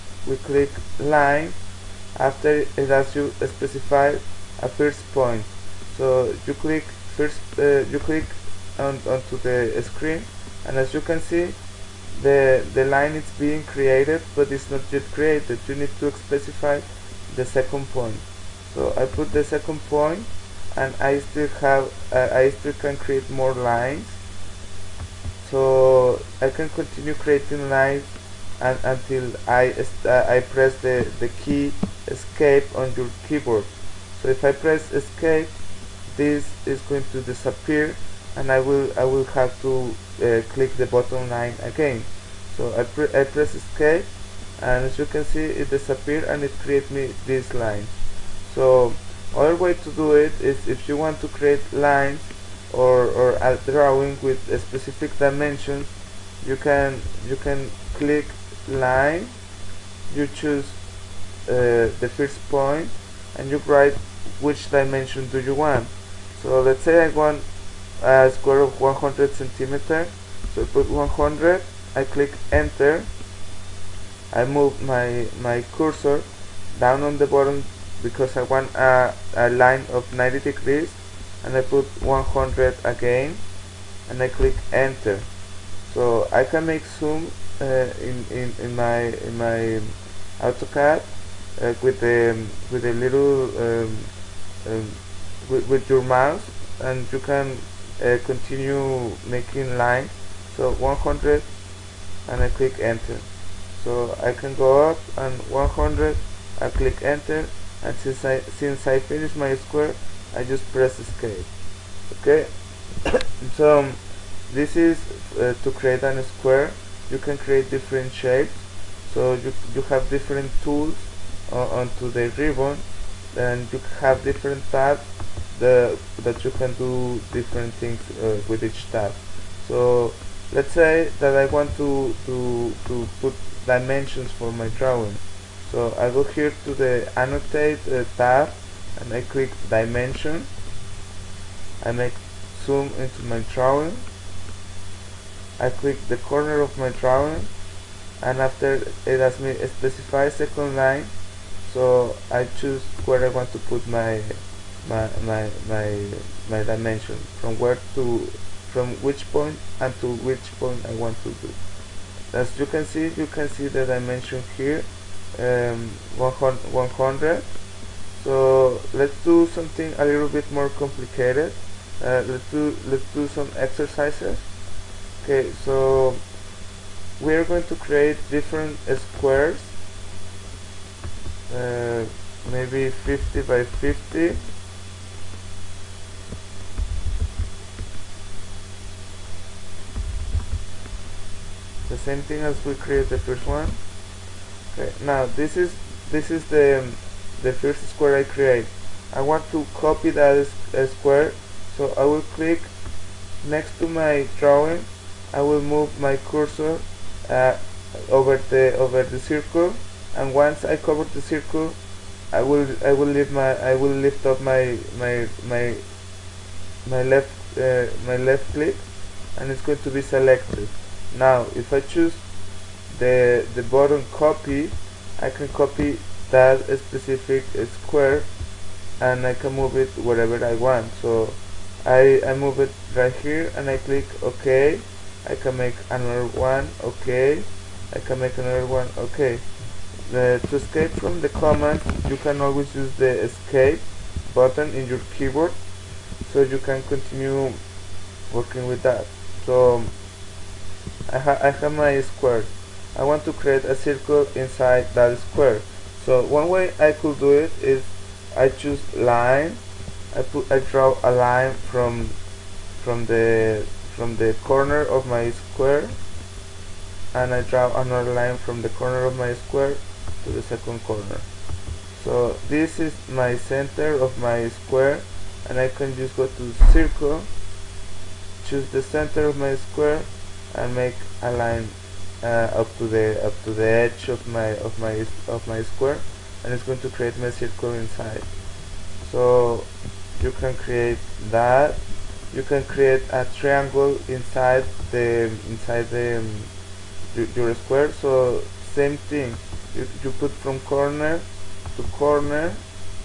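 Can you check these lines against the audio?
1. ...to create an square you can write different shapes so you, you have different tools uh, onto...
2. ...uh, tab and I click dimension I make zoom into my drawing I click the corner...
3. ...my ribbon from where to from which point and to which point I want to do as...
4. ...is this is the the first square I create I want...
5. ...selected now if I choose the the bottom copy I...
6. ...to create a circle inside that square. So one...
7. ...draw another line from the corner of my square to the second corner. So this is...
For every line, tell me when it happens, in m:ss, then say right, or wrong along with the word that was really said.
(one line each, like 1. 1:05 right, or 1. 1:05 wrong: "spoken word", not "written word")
1. 1:55 wrong: "create", not "write"
2. 2:17 right
3. 2:36 wrong: "dimension", not "ribbon"
4. 3:15 right
5. 3:40 right
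6. 4:13 right
7. 4:27 right.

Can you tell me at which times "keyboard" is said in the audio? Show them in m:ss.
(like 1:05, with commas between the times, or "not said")
0:33, 4:05.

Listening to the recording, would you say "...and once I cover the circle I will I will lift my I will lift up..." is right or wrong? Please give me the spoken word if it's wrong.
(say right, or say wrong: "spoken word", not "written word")
right.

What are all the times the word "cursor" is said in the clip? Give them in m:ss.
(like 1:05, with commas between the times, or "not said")
1:15, 3:26.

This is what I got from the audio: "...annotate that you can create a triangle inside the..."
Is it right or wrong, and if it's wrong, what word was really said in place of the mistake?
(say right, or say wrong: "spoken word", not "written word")
wrong: "create", not "annotate".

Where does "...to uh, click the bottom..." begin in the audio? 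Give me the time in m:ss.
0:39.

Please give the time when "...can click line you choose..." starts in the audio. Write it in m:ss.
0:57.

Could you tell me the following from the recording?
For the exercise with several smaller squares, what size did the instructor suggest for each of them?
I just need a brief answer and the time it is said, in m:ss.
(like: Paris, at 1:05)
50 by 50, at 3:02.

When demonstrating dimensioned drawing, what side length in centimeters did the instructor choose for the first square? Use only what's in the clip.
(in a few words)
100 centimeters.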